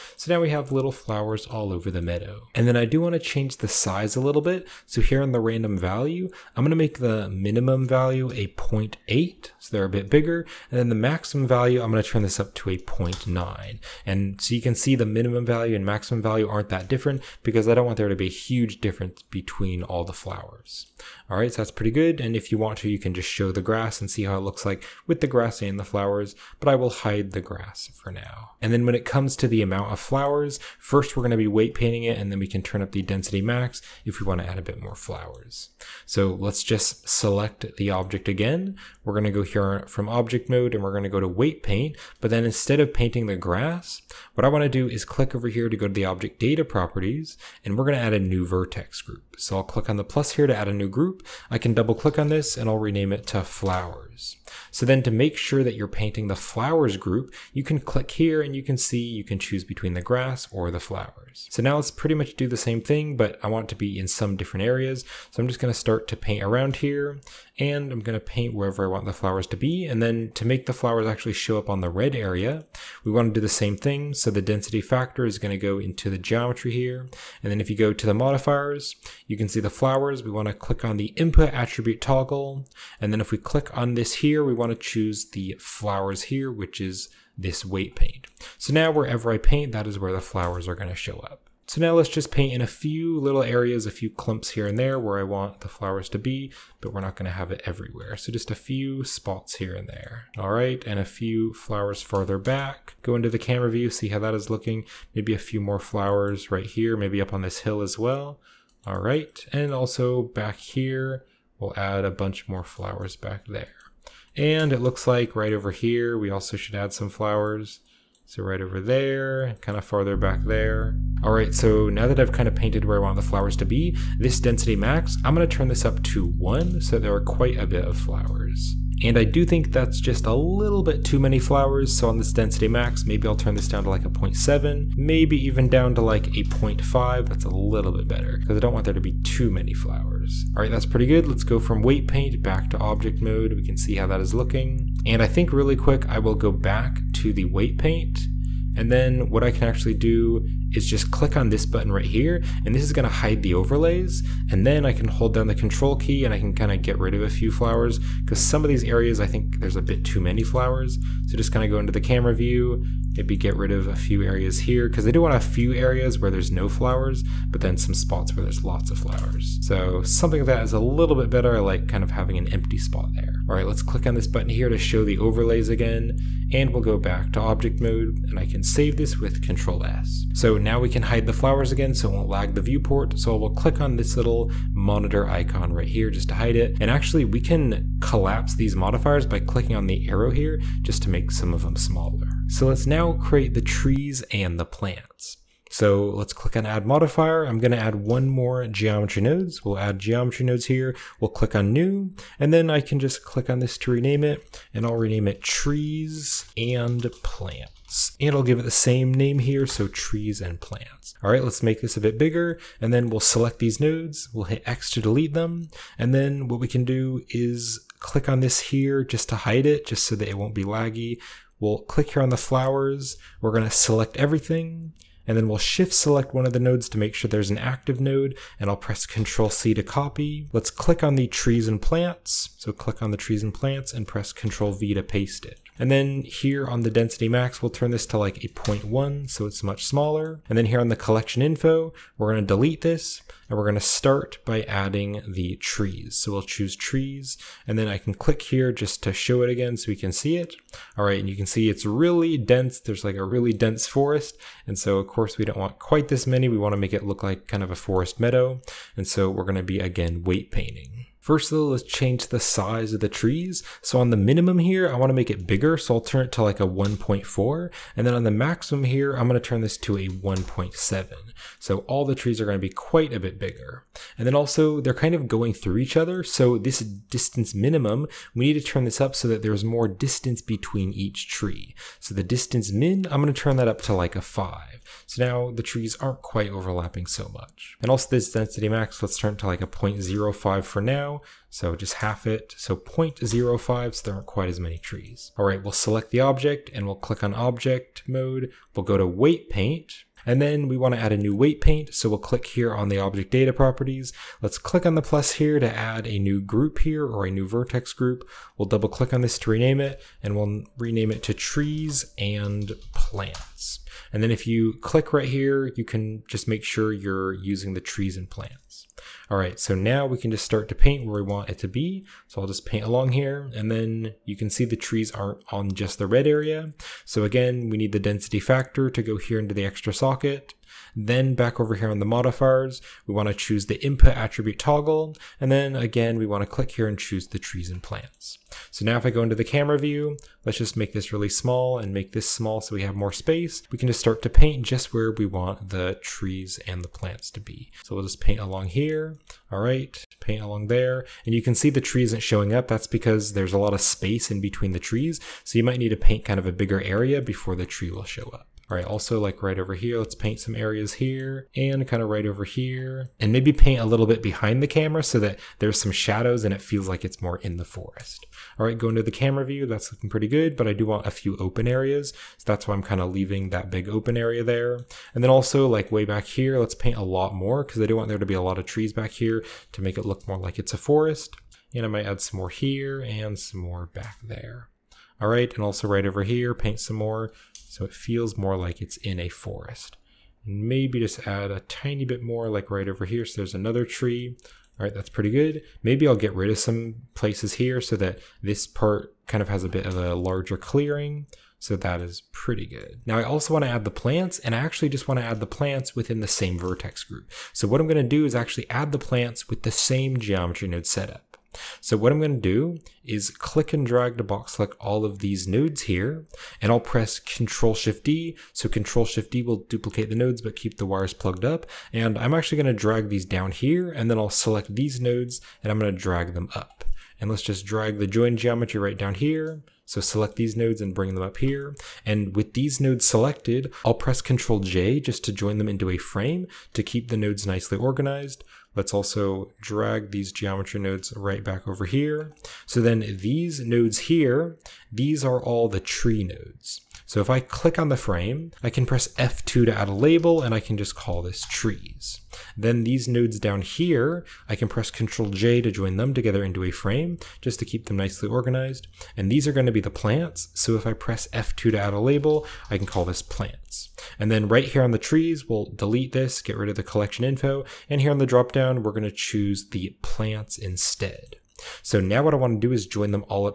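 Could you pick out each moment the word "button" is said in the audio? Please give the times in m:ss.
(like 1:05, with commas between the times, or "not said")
2:31, 2:54.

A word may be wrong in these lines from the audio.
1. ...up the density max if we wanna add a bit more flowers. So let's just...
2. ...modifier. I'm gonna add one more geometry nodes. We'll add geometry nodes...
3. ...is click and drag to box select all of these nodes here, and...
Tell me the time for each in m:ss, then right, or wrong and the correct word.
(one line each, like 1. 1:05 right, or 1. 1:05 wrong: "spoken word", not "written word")
1. 0:32 right
2. 3:16 right
3. 6:53 right.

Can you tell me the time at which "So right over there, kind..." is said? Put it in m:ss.
1:58.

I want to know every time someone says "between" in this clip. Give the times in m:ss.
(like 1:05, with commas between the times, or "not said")
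0:19, 0:59, 4:40, 5:54.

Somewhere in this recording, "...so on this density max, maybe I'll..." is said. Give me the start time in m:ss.
2:11.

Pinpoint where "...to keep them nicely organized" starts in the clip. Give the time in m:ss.
7:37.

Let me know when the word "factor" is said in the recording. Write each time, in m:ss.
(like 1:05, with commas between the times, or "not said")
1:14, 5:28.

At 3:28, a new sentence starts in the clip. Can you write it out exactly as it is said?
And I'll give it the same name here, so trees and plants.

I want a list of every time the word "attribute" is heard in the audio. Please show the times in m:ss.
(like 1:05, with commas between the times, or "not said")
1:21, 5:34.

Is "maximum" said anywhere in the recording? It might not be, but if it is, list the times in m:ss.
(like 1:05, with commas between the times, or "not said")
0:10, 0:15, 4:28.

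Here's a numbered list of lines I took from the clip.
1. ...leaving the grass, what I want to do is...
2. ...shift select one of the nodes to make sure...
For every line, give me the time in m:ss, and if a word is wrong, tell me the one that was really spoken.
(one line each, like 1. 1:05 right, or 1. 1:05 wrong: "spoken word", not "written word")
1. 0:42 wrong: "painting", not "leaving"
2. 3:45 right.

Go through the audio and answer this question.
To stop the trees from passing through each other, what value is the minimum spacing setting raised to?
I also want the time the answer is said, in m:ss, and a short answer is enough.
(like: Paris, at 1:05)
5, at 4:44.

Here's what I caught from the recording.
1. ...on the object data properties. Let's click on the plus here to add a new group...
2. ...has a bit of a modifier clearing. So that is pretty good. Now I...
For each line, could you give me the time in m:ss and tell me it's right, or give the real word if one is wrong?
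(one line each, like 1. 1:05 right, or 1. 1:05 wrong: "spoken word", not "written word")
1. 5:02 right
2. 6:39 wrong: "larger", not "modifier".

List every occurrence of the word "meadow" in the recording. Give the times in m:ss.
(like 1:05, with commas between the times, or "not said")
0:02, 4:18.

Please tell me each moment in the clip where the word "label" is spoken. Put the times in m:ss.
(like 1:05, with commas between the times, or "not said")
7:29, 7:41.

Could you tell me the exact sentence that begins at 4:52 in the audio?
So 0.05, so there aren't quite as many trees.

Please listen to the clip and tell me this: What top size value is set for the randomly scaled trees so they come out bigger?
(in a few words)
1.7.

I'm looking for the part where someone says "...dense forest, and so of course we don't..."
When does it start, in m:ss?
4:13.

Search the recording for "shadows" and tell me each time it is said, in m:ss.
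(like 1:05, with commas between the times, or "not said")
6:05.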